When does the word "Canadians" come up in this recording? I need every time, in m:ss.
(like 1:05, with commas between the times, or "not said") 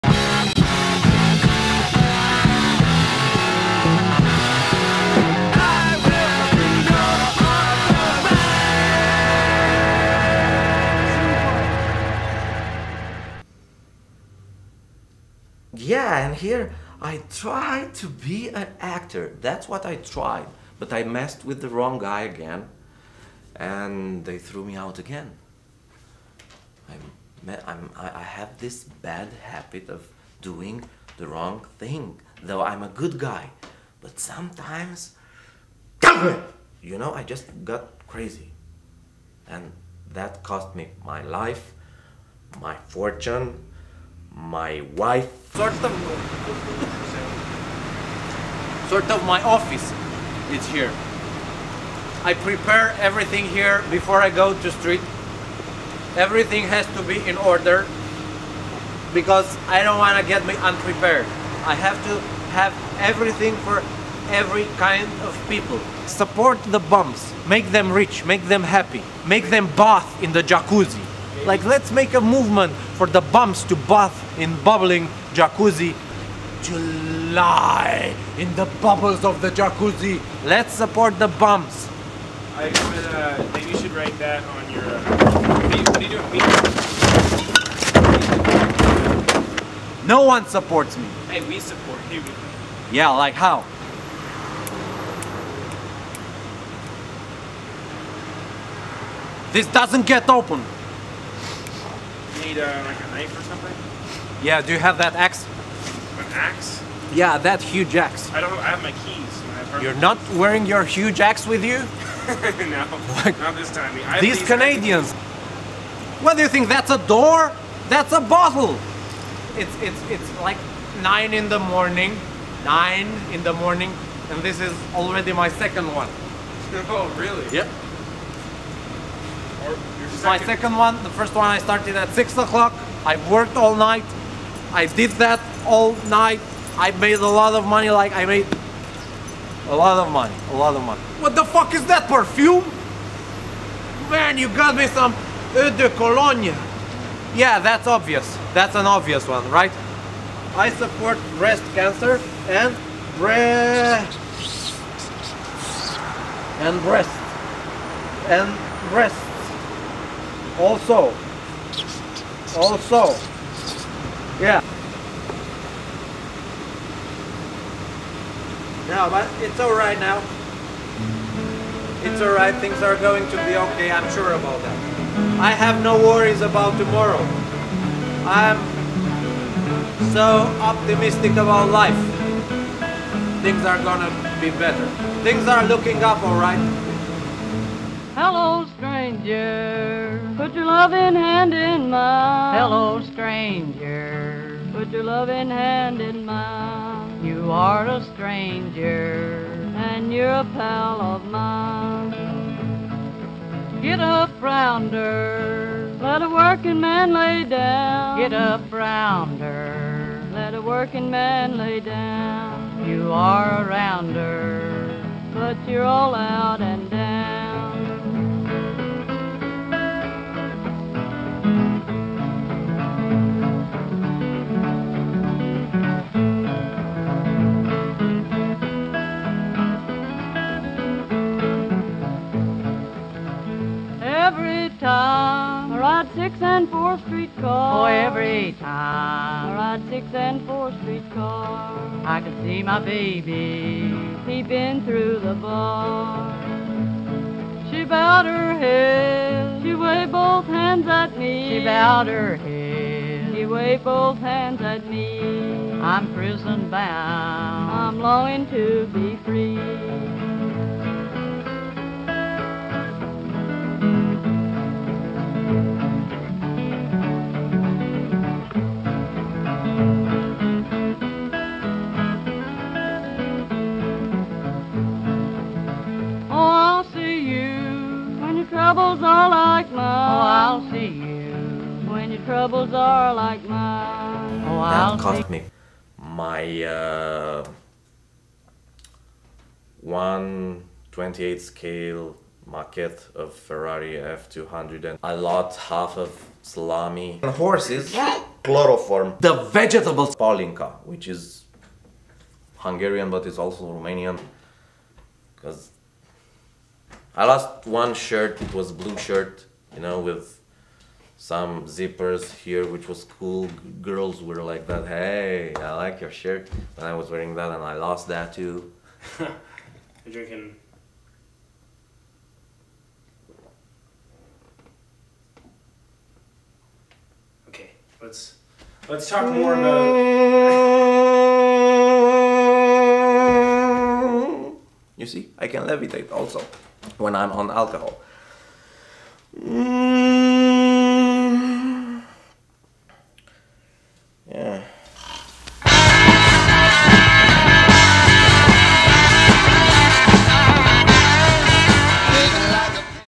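1:54.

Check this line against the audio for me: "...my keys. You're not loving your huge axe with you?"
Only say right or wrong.
wrong.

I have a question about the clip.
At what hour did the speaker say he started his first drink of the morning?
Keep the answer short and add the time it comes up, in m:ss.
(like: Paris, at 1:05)
6 o'clock, at 2:12.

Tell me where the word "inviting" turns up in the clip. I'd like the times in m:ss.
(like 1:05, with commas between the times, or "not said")
not said.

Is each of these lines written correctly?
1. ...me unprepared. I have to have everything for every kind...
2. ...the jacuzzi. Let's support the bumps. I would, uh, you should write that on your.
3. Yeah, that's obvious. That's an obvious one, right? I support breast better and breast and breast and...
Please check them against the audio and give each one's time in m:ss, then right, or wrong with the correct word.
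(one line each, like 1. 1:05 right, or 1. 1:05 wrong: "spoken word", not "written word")
1. 1:00 right
2. 1:19 right
3. 2:27 wrong: "cancer", not "better".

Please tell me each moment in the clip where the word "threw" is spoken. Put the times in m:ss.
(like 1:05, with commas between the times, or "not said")
0:24.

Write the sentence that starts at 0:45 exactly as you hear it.
Sort of, sort of my office is here.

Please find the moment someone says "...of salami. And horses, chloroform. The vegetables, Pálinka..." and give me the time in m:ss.
4:55.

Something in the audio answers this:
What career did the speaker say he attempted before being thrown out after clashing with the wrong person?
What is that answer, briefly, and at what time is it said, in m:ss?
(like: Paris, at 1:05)
Actor, at 0:18.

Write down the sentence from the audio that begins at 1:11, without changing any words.
Like let's make a movement for the bumps to bath in bubbling jacuzzi.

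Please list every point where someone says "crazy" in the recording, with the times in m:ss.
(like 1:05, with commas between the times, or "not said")
0:38.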